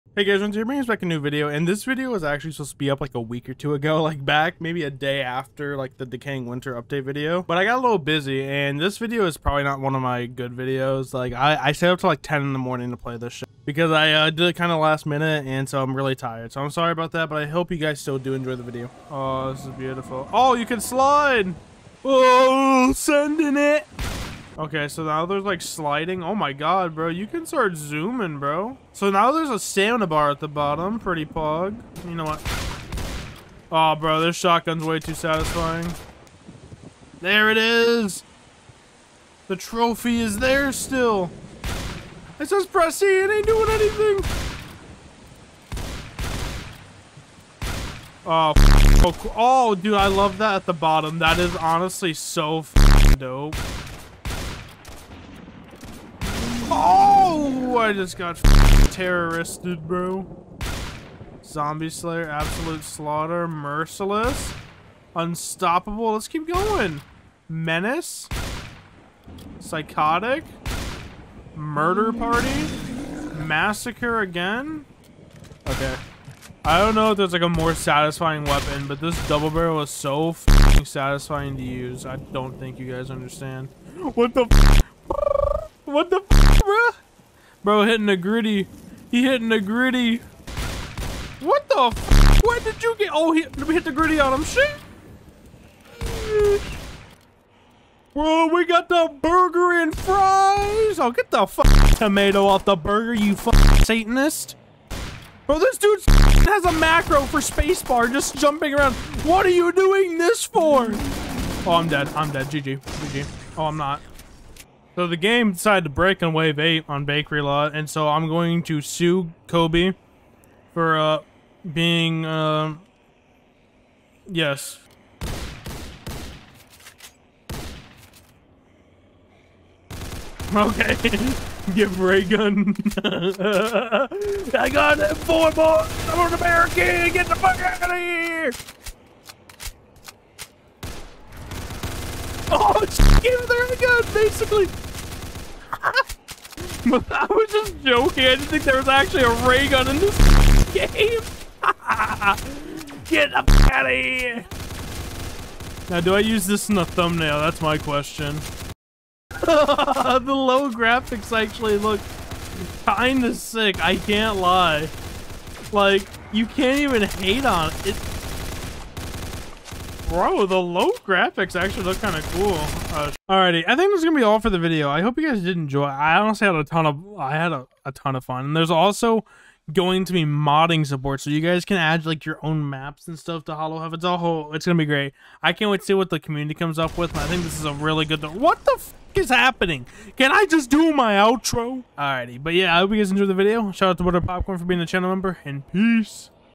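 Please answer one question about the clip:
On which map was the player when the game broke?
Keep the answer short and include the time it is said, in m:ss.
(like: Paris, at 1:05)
Bakery Lot, at 1:57.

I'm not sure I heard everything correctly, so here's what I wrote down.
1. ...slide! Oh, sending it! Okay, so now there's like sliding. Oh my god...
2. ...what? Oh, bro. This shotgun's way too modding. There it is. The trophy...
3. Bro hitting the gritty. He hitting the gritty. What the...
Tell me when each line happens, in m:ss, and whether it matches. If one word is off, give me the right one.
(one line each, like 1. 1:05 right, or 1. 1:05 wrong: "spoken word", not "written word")
1. 0:20 right
2. 0:32 wrong: "satisfying", not "modding"
3. 1:27 right.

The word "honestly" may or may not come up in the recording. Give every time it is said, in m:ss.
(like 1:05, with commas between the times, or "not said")
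0:51, 2:56.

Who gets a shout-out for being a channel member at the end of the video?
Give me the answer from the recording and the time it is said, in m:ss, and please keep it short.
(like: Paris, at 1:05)
Butter Popcorn, at 3:14.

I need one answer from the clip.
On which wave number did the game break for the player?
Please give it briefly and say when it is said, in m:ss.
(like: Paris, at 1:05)
8, at 1:56.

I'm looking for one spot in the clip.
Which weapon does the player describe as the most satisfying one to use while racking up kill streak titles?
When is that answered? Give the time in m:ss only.
1:19.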